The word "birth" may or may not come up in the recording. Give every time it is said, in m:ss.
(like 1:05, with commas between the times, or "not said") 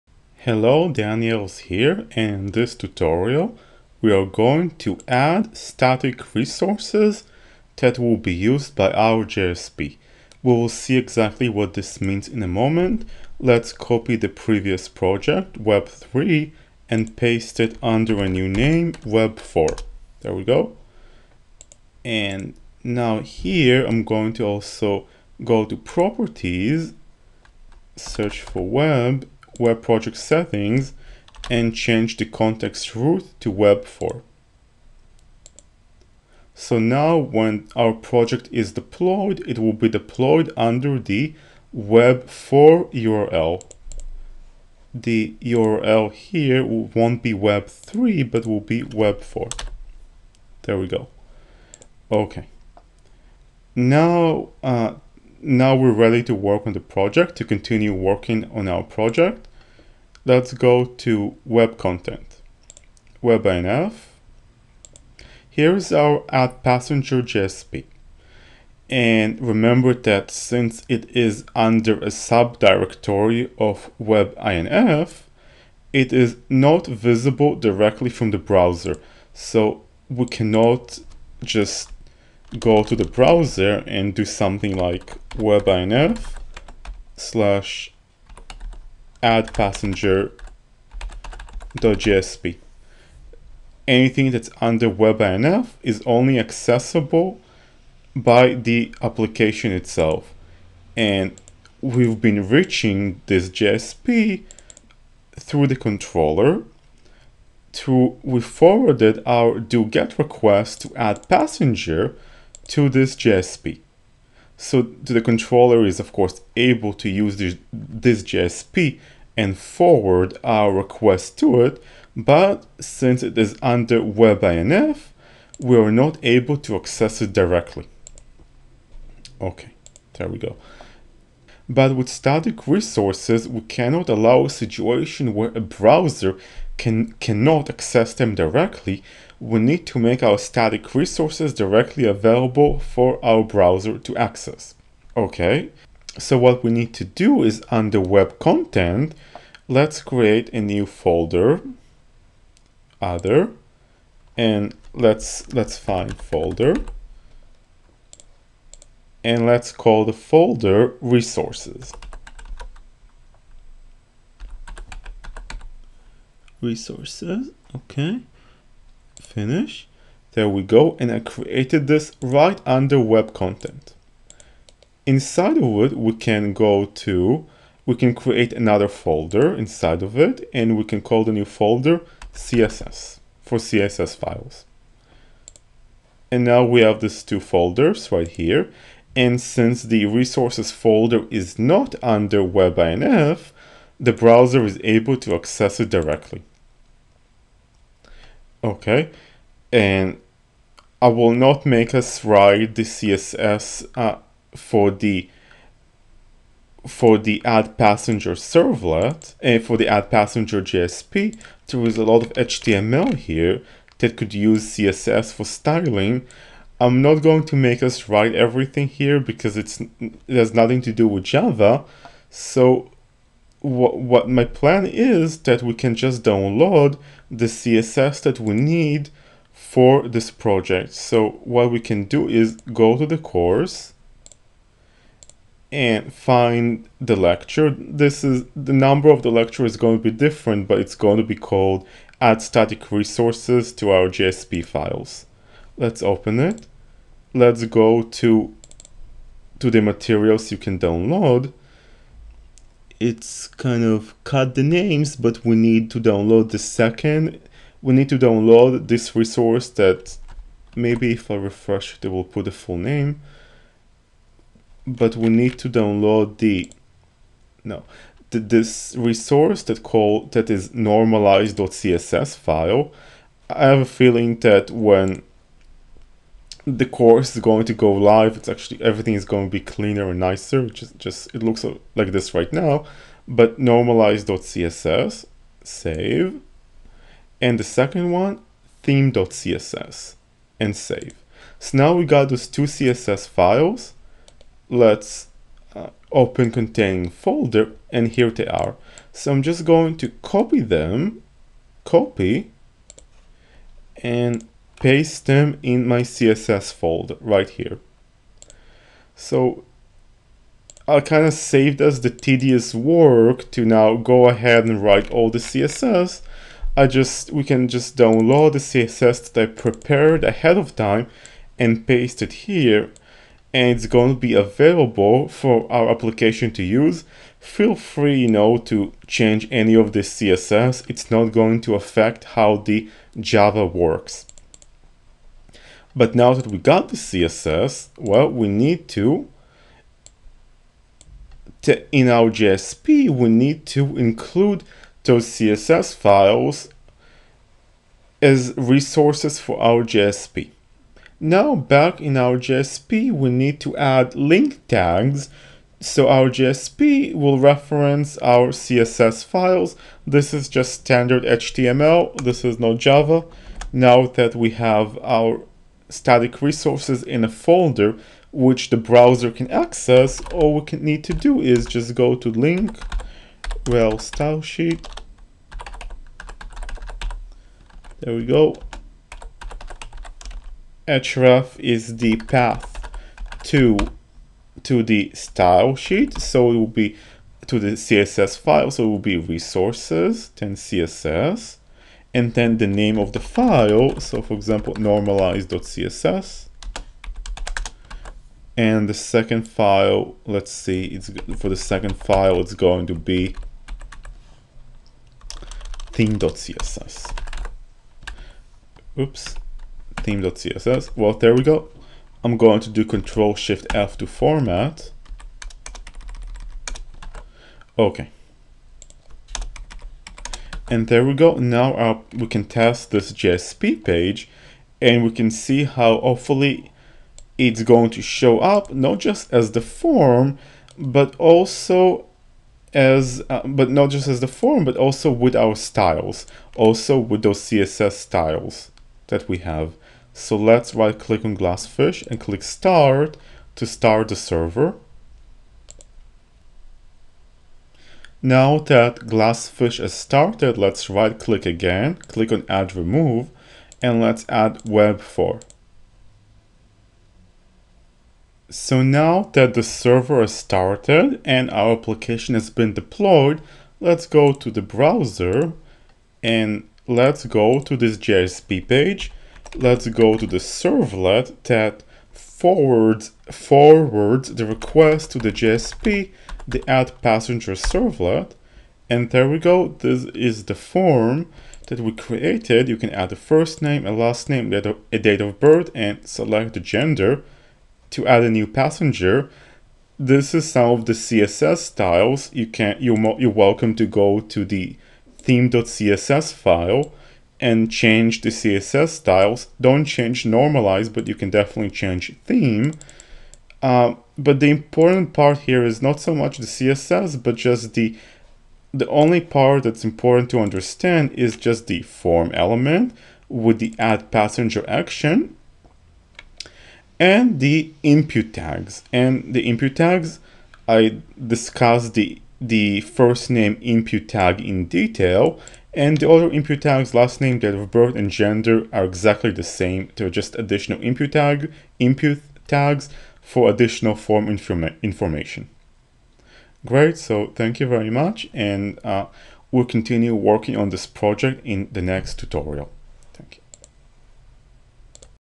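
8:05, 8:47.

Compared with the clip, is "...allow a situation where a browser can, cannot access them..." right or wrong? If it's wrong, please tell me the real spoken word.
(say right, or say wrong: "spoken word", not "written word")
right.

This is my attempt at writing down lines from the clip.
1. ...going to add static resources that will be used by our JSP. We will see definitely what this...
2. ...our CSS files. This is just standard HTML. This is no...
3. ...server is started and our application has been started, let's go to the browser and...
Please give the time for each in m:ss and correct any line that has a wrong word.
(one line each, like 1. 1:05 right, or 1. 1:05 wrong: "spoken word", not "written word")
1. 0:04 wrong: "exactly", not "definitely"
2. 5:58 right
3. 7:39 wrong: "deployed", not "started".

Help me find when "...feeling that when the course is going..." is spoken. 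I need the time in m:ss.
4:33.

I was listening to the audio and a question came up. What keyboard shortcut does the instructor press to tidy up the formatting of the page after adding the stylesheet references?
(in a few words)
Control Shift F.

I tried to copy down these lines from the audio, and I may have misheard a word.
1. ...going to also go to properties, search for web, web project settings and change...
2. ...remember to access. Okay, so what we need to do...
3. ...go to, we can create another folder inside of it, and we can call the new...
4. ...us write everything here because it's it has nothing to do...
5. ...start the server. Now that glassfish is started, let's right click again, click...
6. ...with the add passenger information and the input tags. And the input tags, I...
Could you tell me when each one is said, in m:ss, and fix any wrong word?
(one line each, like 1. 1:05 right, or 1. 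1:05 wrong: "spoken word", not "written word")
1. 0:24 right
2. 2:23 wrong: "browser", not "remember"
3. 2:56 right
4. 3:37 right
5. 7:23 right
6. 8:33 wrong: "action", not "information".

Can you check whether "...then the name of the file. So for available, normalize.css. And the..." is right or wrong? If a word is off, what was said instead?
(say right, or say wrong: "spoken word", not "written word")
wrong: "example", not "available".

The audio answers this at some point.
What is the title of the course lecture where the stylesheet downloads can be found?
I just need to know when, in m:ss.
4:02.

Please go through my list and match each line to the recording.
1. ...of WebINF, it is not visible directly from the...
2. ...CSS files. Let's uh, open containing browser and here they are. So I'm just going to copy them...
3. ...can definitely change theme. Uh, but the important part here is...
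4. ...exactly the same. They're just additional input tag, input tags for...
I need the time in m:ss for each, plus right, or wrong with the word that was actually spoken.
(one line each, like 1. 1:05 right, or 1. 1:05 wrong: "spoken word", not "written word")
1. 1:13 right
2. 4:52 wrong: "folder", not "browser"
3. 8:21 right
4. 8:48 right.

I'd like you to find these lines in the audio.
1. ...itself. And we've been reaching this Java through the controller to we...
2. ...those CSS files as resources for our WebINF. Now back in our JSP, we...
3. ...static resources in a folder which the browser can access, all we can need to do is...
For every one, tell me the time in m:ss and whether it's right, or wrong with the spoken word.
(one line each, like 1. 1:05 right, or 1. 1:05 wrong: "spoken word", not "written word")
1. 1:39 wrong: "JSP", not "Java"
2. 5:45 wrong: "JSP", not "WebINF"
3. 6:05 right.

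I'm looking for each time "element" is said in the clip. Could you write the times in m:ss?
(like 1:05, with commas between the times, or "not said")
8:32.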